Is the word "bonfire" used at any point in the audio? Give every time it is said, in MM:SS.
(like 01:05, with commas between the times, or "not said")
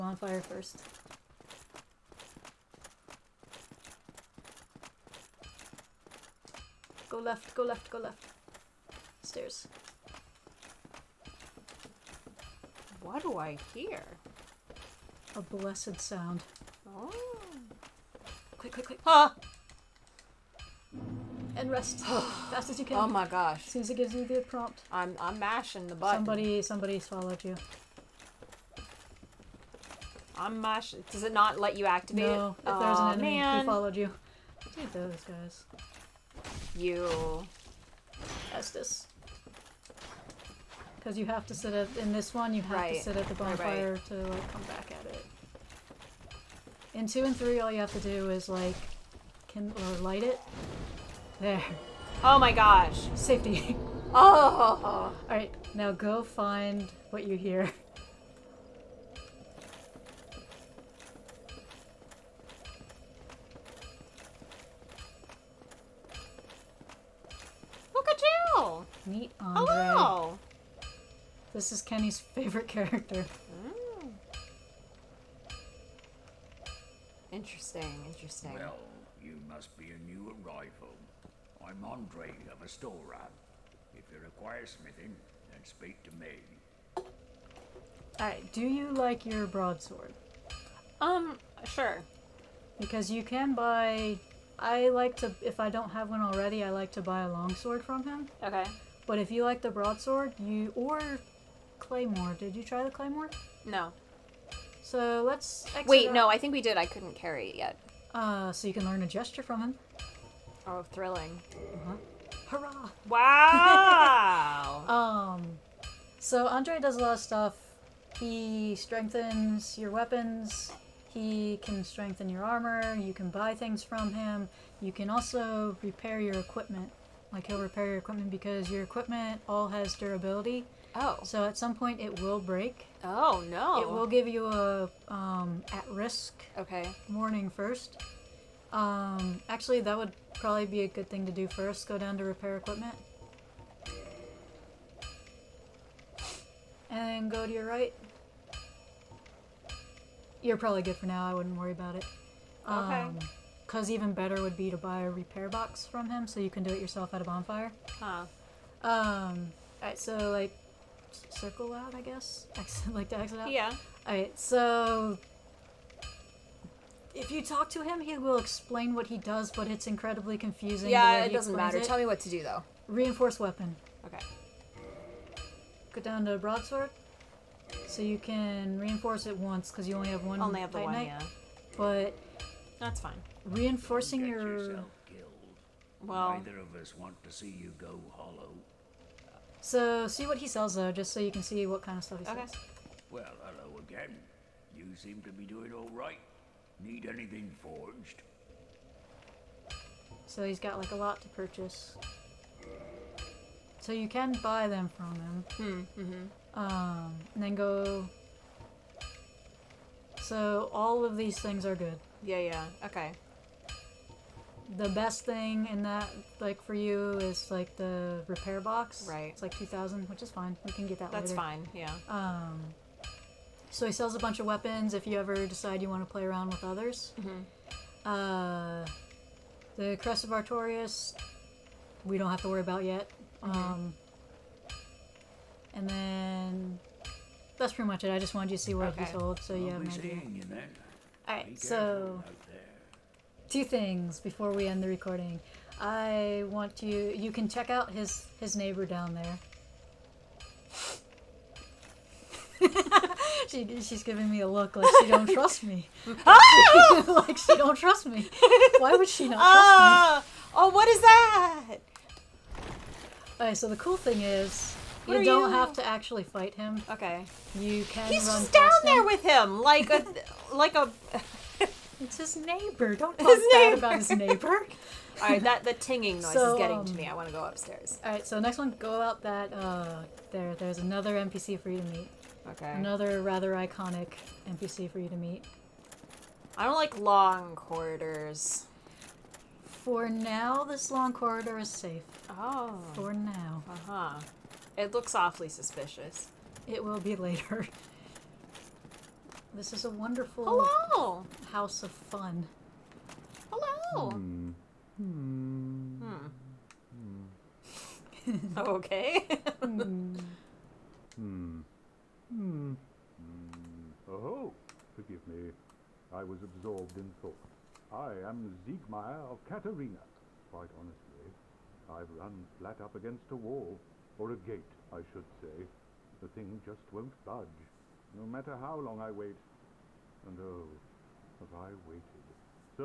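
00:43, 02:37.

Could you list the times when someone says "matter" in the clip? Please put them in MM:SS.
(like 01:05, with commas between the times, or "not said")
02:51, 05:28.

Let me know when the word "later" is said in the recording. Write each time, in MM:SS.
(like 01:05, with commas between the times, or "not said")
03:41, 04:57.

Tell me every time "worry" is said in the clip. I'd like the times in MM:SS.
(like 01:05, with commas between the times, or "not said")
02:31, 03:52.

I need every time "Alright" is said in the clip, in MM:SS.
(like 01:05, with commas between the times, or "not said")
00:55, 01:28.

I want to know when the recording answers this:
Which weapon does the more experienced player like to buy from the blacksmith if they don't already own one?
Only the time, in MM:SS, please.
01:37.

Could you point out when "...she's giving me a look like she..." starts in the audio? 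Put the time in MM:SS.
04:13.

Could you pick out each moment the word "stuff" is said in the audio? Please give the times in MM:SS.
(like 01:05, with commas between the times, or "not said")
01:57, 03:12.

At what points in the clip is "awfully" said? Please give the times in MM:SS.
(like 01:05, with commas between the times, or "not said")
04:55.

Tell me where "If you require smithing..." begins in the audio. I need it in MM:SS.
01:23.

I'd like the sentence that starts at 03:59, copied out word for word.
he sold so yeah maybe all right so two things before we end the recording.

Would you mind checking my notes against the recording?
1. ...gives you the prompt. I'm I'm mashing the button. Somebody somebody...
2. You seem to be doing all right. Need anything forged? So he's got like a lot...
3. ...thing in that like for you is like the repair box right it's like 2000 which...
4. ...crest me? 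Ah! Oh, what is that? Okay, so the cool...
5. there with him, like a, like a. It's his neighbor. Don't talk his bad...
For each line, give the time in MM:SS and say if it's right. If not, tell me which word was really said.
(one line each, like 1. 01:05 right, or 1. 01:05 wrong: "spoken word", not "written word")
1. 00:23 right
2. 03:14 right
3. 03:35 right
4. 04:19 wrong: "trust", not "crest"
5. 04:28 right.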